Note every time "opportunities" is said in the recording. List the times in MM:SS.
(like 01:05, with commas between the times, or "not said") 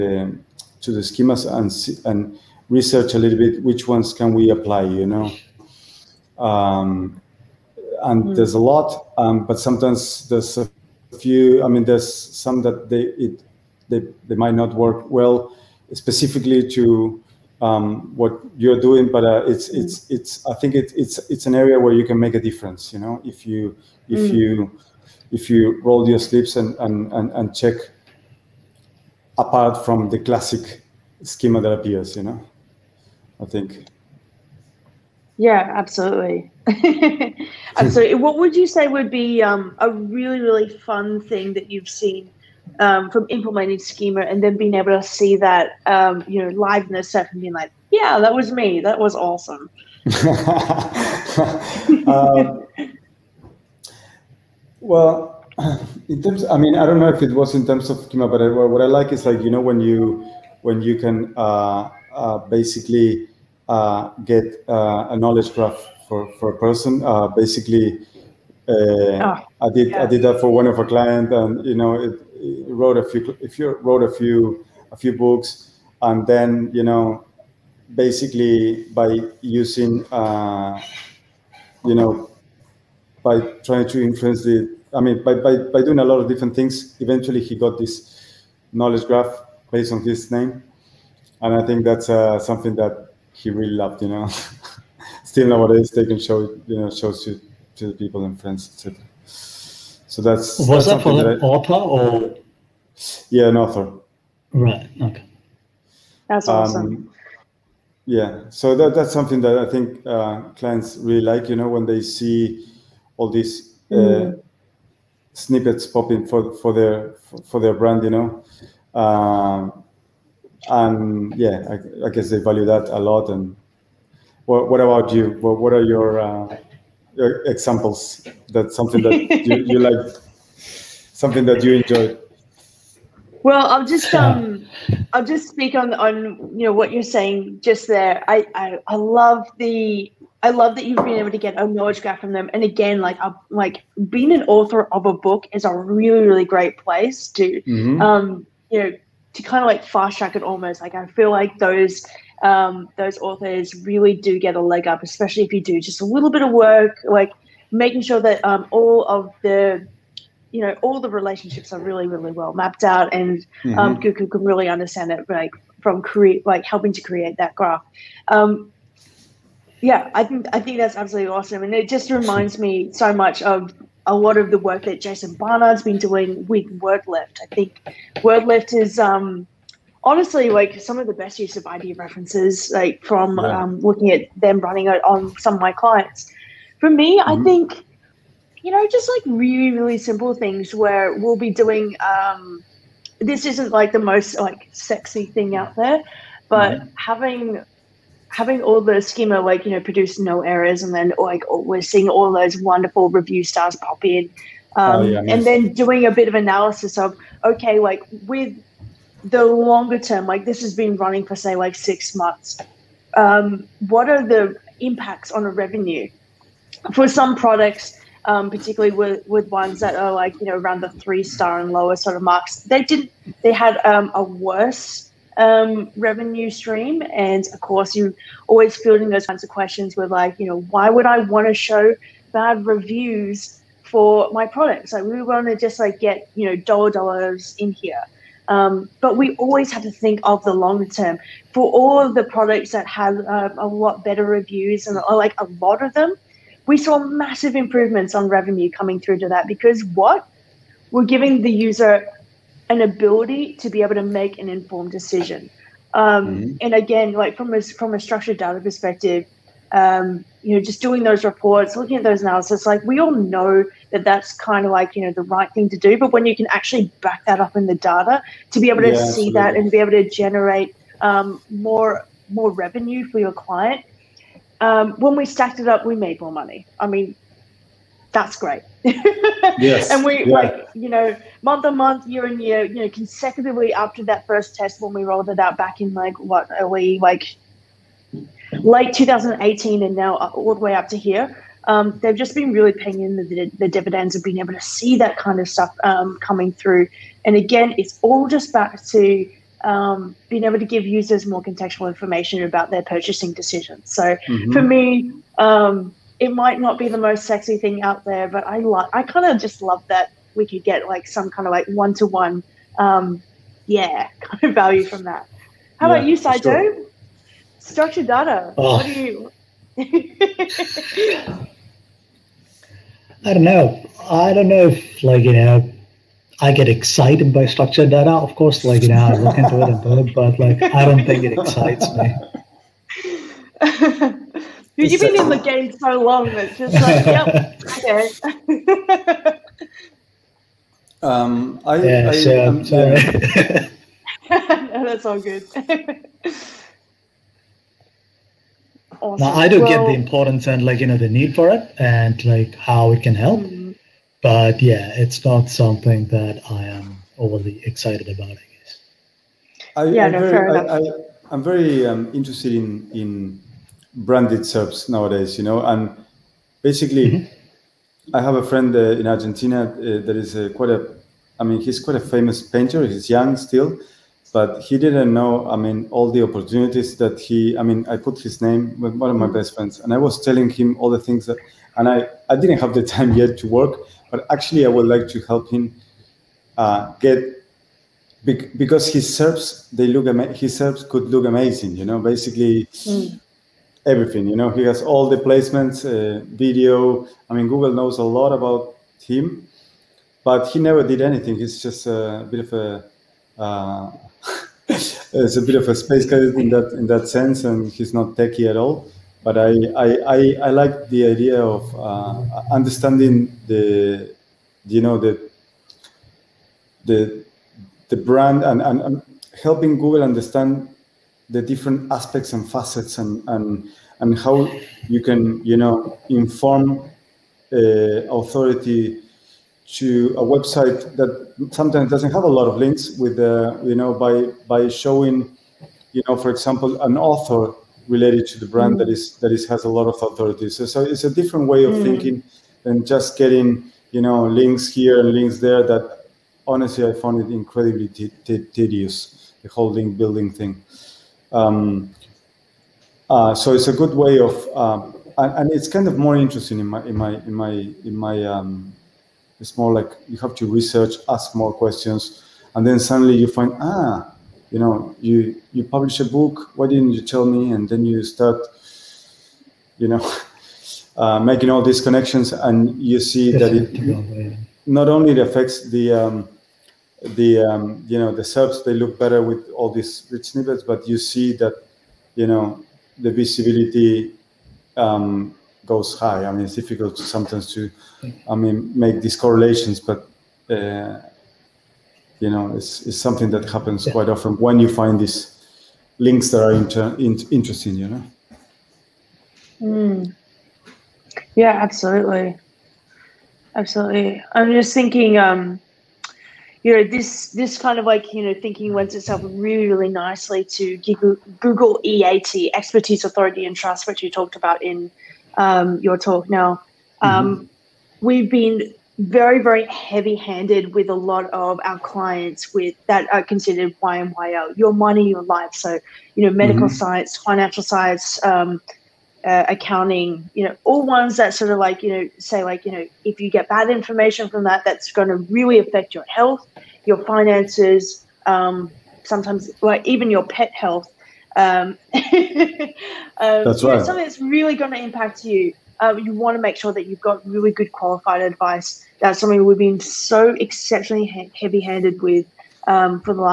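06:16.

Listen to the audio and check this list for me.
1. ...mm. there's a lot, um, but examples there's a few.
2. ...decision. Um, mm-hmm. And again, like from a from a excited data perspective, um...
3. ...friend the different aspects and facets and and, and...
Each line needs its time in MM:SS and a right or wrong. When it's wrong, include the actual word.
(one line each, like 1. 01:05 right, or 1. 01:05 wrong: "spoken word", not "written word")
1. 00:08 wrong: "sometimes", not "examples"
2. 04:14 wrong: "structured", not "excited"
3. 07:00 wrong: "understand", not "friend".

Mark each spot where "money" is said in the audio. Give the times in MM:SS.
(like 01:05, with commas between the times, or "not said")
04:36, 08:44.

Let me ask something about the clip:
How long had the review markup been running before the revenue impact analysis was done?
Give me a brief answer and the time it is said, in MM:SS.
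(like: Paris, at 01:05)
6 months, at 03:31.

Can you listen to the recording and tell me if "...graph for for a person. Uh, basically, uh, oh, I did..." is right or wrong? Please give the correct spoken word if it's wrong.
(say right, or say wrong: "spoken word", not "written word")
right.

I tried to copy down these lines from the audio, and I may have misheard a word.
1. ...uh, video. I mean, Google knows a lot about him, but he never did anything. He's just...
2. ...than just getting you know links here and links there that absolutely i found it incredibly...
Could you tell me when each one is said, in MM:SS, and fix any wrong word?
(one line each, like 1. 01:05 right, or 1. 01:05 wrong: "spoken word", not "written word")
1. 06:35 right
2. 07:22 wrong: "honestly", not "absolutely".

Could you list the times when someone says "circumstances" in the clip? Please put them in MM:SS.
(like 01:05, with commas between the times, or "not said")
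not said.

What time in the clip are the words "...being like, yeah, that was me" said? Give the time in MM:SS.
00:47.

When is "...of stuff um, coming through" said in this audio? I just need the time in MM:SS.
04:55.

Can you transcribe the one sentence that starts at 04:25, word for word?
But when you can actually back that up in the data to be able to yeah, see absolutely.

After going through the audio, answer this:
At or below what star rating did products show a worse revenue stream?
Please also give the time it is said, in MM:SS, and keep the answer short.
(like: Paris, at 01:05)
3 stars, at 03:40.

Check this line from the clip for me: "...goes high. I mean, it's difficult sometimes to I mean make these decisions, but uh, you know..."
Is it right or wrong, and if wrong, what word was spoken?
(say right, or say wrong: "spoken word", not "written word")
wrong: "correlations", not "decisions".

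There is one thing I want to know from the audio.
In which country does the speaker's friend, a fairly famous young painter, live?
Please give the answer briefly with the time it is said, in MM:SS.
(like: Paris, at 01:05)
Argentina, at 06:09.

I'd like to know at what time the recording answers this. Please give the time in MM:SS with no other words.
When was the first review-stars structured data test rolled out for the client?
04:48.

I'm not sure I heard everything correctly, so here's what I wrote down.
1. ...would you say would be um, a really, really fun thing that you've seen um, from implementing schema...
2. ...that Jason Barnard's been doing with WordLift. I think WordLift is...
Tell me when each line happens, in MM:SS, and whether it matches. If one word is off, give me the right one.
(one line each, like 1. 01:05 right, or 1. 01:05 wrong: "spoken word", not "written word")
1. 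00:38 right
2. 02:54 right.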